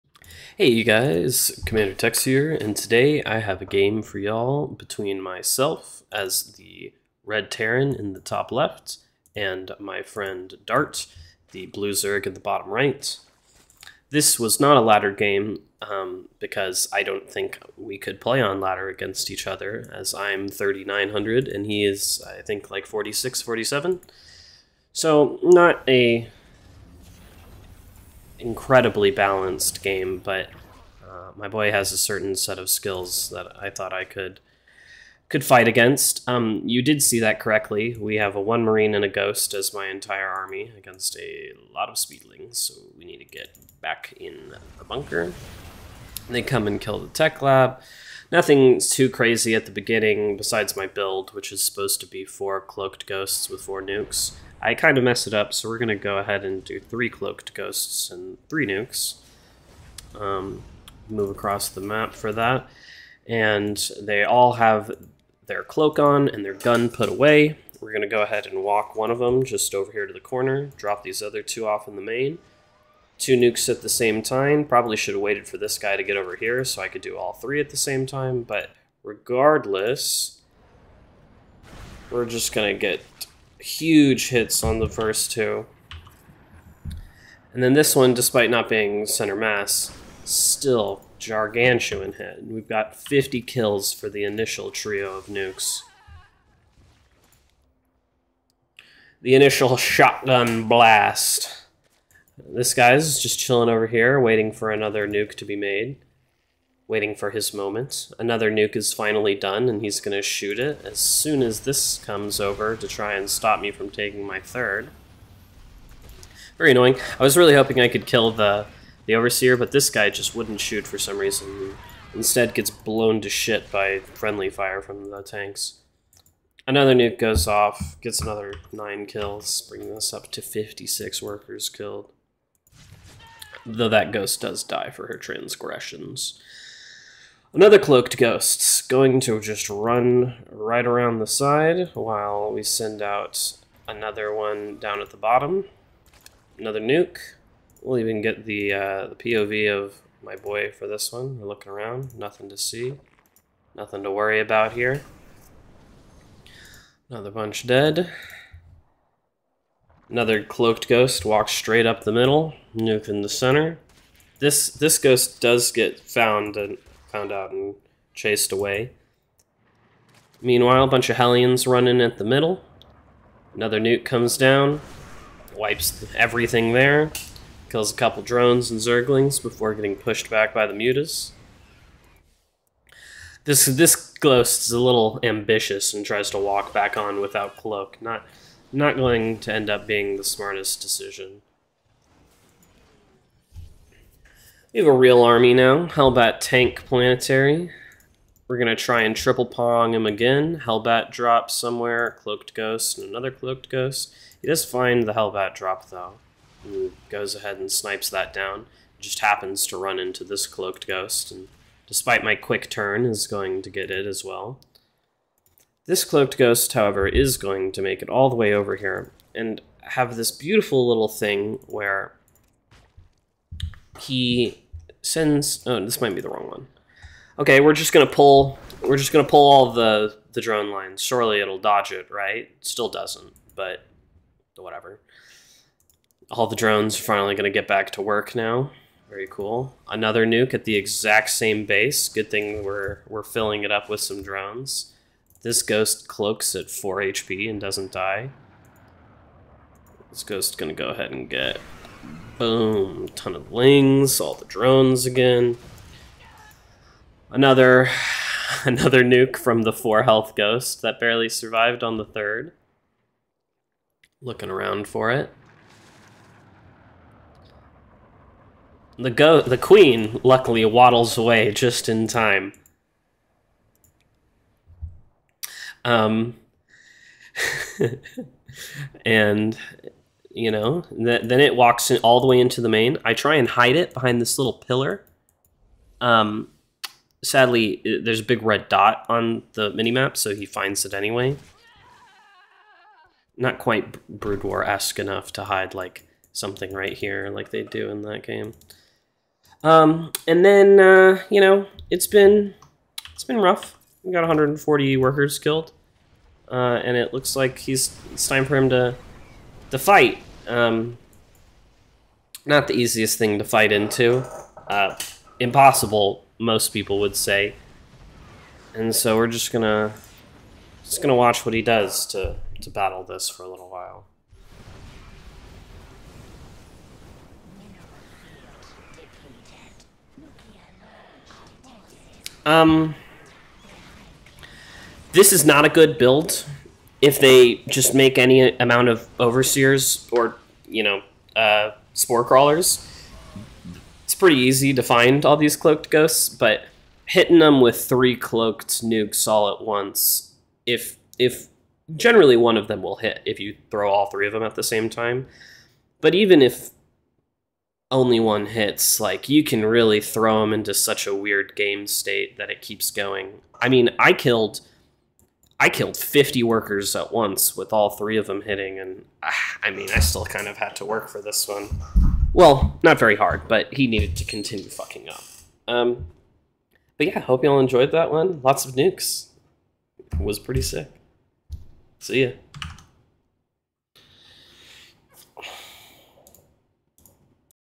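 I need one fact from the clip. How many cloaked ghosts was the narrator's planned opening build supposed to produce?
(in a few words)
4 cloaked ghosts.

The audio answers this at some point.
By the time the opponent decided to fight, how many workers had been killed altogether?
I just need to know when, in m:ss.
5:04.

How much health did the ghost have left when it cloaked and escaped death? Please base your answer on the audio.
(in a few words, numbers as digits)
4 HP.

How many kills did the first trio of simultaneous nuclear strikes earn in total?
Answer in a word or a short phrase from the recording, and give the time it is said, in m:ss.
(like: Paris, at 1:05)
50, at 1:32.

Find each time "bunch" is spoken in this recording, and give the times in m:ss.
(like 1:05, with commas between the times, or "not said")
2:37, 2:50.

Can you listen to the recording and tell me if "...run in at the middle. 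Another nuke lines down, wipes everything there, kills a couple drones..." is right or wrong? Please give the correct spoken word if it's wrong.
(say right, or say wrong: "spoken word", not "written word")
wrong: "comes", not "lines".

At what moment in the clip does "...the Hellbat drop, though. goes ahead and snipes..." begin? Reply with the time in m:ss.
3:25.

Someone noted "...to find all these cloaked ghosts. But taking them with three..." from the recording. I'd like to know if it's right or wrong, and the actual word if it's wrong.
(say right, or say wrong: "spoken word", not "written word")
wrong: "hitting", not "taking".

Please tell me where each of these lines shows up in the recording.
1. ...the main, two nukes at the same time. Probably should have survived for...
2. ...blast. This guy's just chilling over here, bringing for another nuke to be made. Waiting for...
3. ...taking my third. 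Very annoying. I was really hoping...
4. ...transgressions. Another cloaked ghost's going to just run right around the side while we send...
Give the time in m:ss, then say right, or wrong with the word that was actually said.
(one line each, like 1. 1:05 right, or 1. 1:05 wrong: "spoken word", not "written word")
1. 1:11 wrong: "waited", not "survived"
2. 1:40 wrong: "waiting", not "bringing"
3. 1:53 right
4. 2:15 right.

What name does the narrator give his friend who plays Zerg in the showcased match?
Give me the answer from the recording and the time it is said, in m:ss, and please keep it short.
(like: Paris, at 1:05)
Dart, at 0:10.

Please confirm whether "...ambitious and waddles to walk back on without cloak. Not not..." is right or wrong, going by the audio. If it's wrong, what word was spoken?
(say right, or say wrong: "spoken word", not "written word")
wrong: "tries", not "waddles".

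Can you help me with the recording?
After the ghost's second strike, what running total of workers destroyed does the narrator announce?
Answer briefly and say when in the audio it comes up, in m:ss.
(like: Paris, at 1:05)
56, at 2:10.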